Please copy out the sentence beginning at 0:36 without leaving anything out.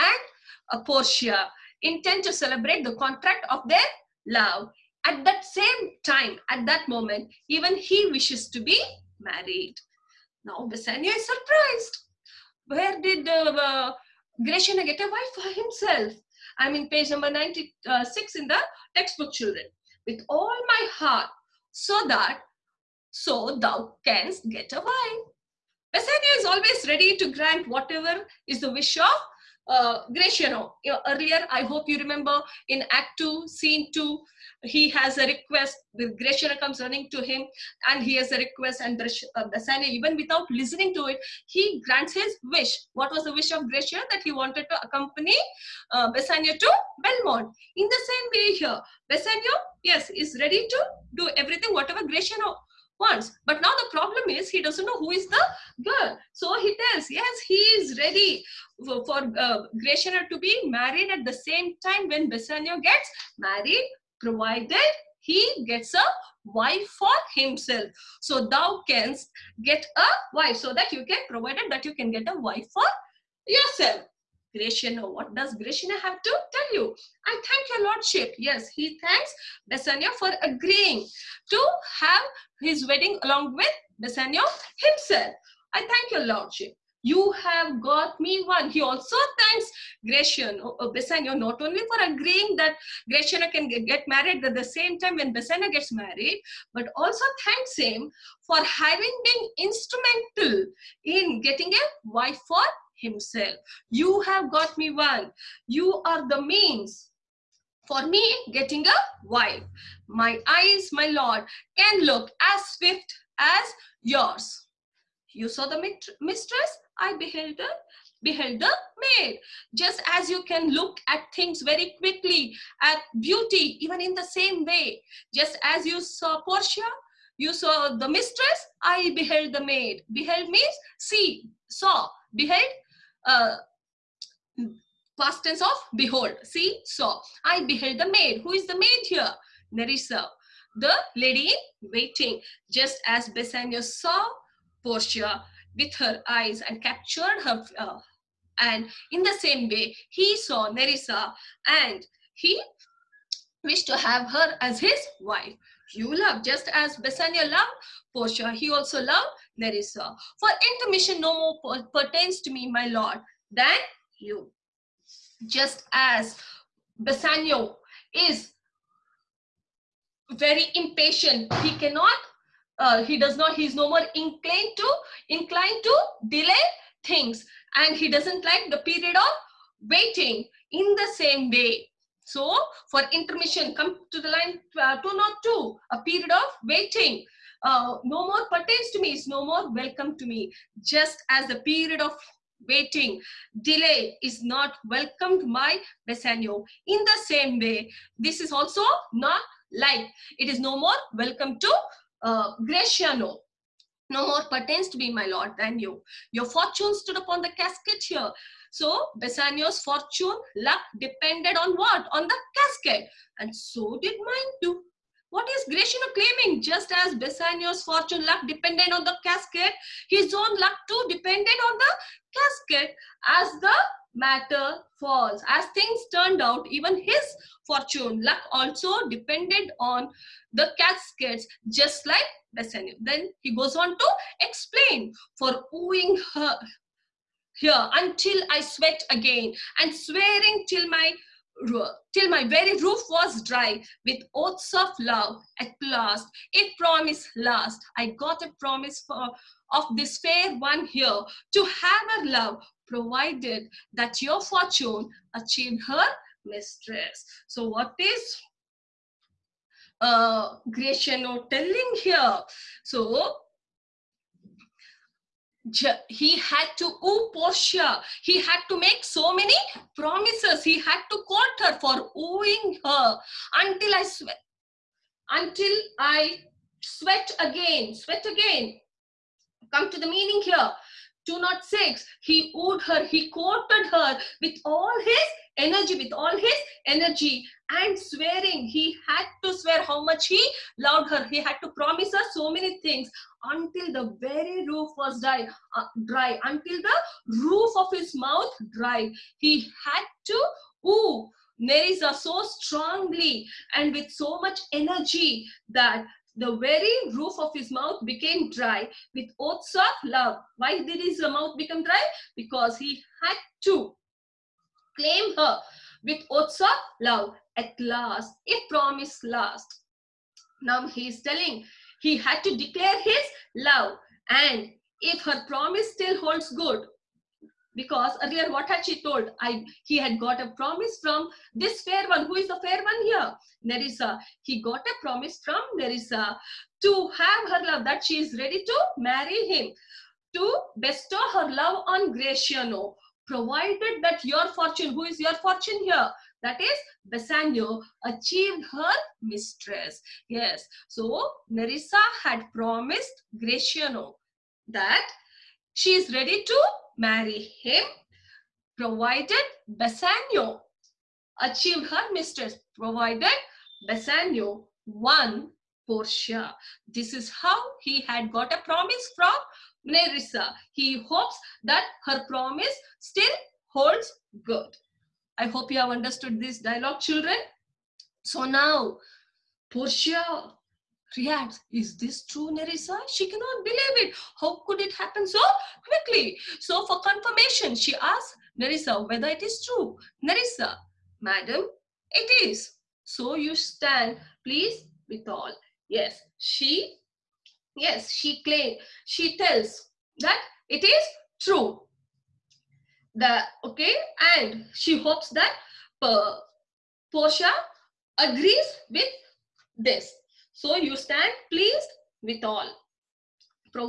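Gratiano comes running to him and he has a request and Bassanio, uh, even without listening to it, he grants his wish.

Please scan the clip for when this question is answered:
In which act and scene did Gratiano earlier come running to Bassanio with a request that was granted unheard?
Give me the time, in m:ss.
0:32.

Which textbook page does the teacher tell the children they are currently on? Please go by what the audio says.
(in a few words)
96.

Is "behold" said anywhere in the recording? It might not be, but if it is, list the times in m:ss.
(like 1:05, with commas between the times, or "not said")
2:15.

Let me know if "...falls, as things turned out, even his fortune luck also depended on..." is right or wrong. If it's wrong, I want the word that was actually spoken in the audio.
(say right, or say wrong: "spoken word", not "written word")
right.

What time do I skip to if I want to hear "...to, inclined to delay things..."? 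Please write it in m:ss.
2:54.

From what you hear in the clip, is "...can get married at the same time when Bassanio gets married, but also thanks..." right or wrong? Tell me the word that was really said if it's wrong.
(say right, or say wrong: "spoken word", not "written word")
right.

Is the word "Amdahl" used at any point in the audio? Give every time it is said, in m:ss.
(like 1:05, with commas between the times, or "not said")
not said.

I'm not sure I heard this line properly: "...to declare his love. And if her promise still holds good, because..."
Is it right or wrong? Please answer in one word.
right.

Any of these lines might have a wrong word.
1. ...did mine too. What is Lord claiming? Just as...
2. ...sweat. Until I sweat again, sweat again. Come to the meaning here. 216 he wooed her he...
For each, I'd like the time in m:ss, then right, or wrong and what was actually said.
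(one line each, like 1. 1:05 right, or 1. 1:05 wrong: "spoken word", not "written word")
1. 3:34 wrong: "Gratiano", not "Lord"
2. 4:34 wrong: "206", not "216".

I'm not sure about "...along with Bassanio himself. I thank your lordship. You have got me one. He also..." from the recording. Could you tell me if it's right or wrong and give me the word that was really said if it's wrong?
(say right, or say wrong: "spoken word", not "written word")
right.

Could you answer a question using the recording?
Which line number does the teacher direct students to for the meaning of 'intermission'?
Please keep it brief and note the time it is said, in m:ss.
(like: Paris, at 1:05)
202, at 3:05.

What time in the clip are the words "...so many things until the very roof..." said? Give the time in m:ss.
4:52.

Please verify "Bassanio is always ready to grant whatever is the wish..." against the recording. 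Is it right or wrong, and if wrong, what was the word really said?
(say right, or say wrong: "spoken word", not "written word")
right.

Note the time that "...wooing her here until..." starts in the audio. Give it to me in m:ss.
3:55.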